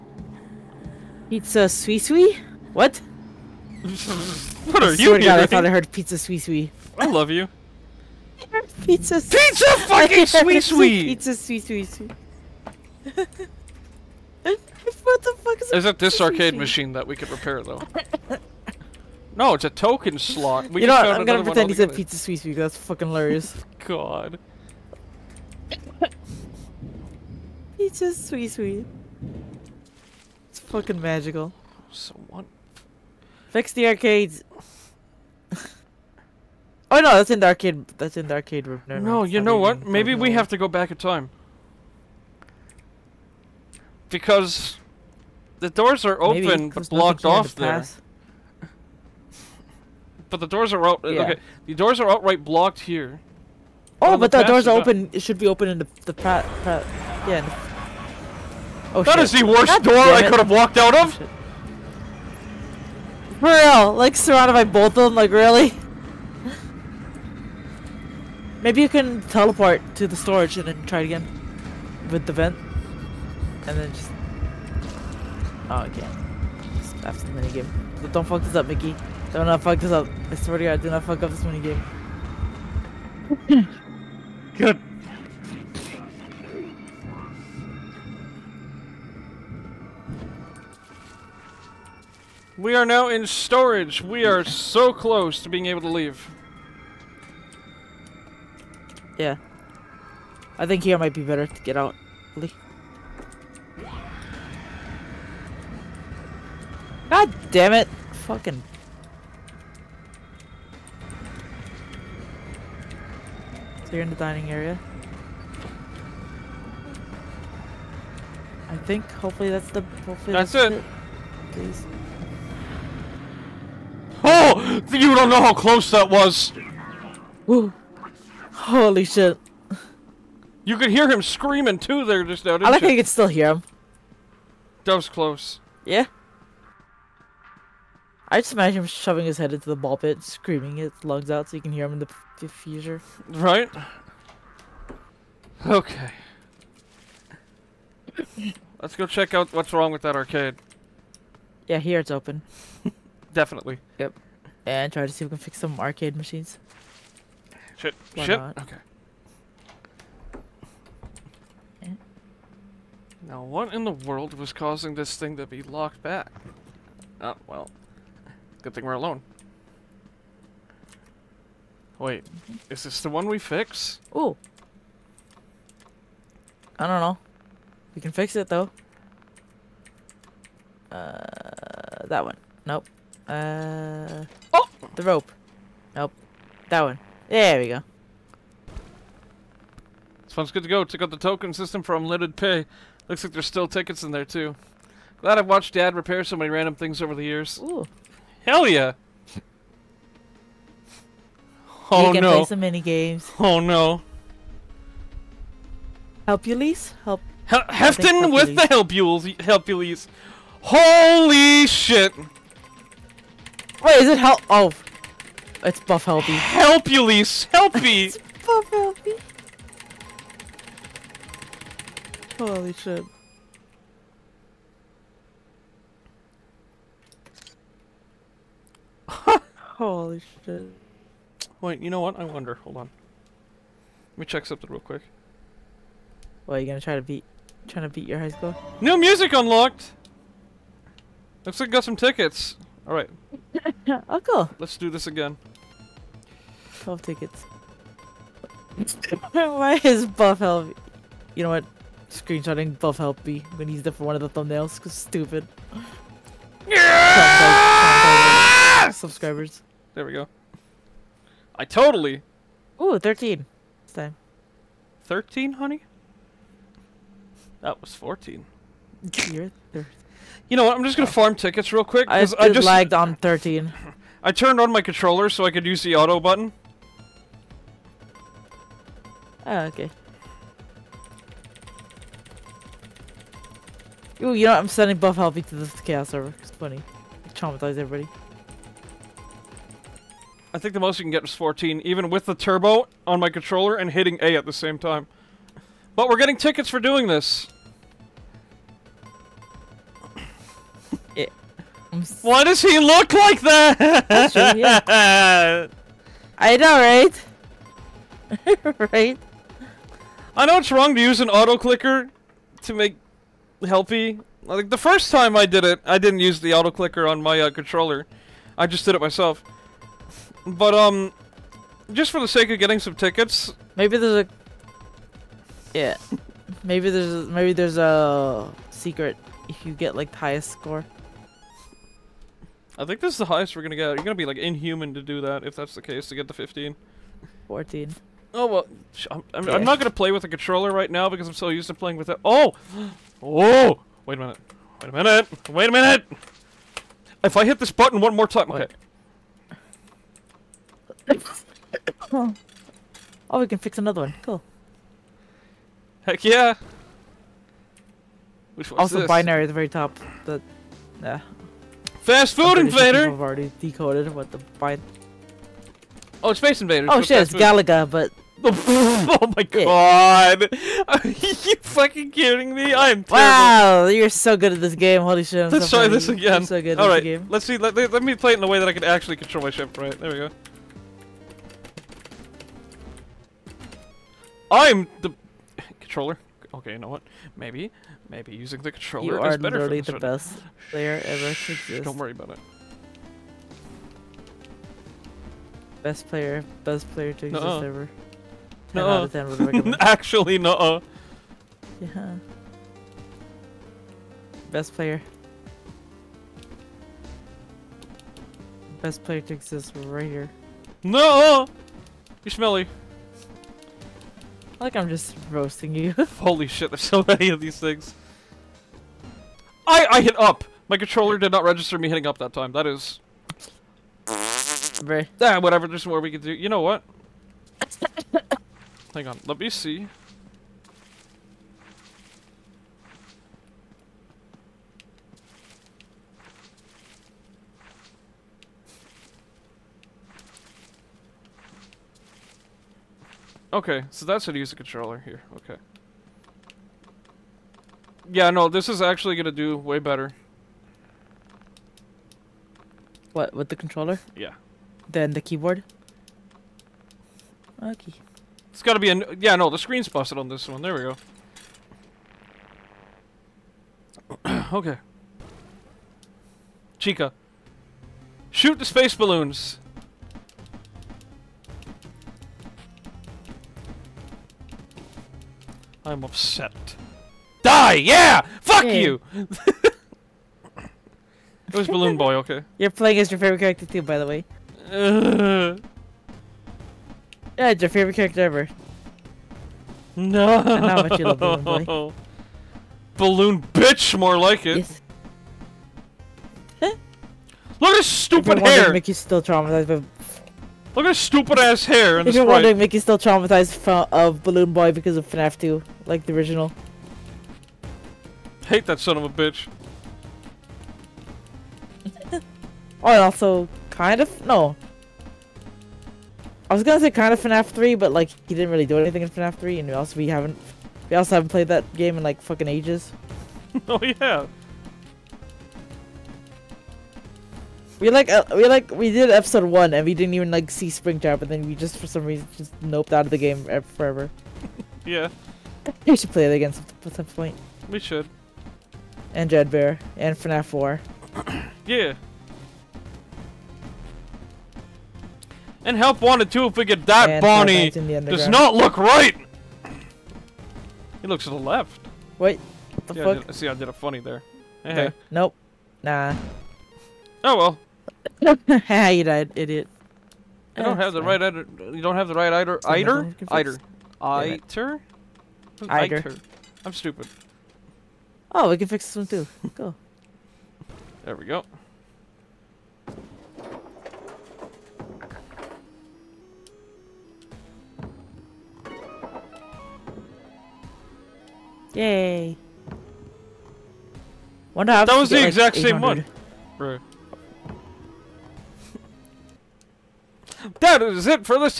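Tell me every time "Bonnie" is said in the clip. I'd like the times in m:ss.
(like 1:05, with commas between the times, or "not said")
9:07.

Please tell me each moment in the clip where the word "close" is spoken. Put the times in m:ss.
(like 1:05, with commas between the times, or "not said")
1:34, 2:05, 2:15.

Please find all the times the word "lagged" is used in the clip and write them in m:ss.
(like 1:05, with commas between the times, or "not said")
4:32.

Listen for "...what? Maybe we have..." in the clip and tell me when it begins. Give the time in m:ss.
0:39.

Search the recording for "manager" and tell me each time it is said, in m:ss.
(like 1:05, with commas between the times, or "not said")
not said.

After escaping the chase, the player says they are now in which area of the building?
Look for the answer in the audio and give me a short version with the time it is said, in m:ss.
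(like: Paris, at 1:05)
dining area, at 1:53.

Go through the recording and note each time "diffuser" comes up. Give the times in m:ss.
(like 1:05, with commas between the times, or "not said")
2:22.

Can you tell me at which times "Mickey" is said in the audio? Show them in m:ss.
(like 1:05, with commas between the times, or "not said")
1:18, 8:22.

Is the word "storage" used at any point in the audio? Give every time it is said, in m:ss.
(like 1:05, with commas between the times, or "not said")
1:10, 1:33.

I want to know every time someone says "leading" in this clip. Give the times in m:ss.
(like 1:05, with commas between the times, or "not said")
not said.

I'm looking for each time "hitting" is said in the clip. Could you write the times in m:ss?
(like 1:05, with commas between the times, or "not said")
4:53, 7:01.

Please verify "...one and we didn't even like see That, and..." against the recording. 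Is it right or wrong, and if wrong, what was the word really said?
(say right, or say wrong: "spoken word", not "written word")
wrong: "Springtrap", not "That".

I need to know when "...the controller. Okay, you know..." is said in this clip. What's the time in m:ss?
6:25.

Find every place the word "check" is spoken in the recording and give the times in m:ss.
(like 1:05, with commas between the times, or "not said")
2:29, 3:10, 3:54.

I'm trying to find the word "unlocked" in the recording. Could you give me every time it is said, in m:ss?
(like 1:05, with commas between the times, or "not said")
3:59.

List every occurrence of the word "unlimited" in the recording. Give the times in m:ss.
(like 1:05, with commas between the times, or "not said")
3:11.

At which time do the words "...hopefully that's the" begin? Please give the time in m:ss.
1:59.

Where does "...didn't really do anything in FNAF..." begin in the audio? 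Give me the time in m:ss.
8:38.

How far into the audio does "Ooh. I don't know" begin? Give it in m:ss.
2:54.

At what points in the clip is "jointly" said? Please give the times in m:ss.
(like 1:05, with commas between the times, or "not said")
not said.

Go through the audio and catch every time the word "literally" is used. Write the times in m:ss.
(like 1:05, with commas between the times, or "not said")
6:29.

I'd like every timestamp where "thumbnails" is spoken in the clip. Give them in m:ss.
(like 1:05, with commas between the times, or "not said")
4:14.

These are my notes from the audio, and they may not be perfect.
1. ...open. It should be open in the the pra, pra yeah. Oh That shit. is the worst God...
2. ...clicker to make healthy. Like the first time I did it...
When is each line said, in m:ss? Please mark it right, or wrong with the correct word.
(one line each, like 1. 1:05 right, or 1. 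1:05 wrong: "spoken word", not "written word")
1. 0:54 right
2. 5:11 right.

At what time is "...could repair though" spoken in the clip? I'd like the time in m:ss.
0:17.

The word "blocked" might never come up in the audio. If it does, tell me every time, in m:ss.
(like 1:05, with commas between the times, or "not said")
0:46, 0:52.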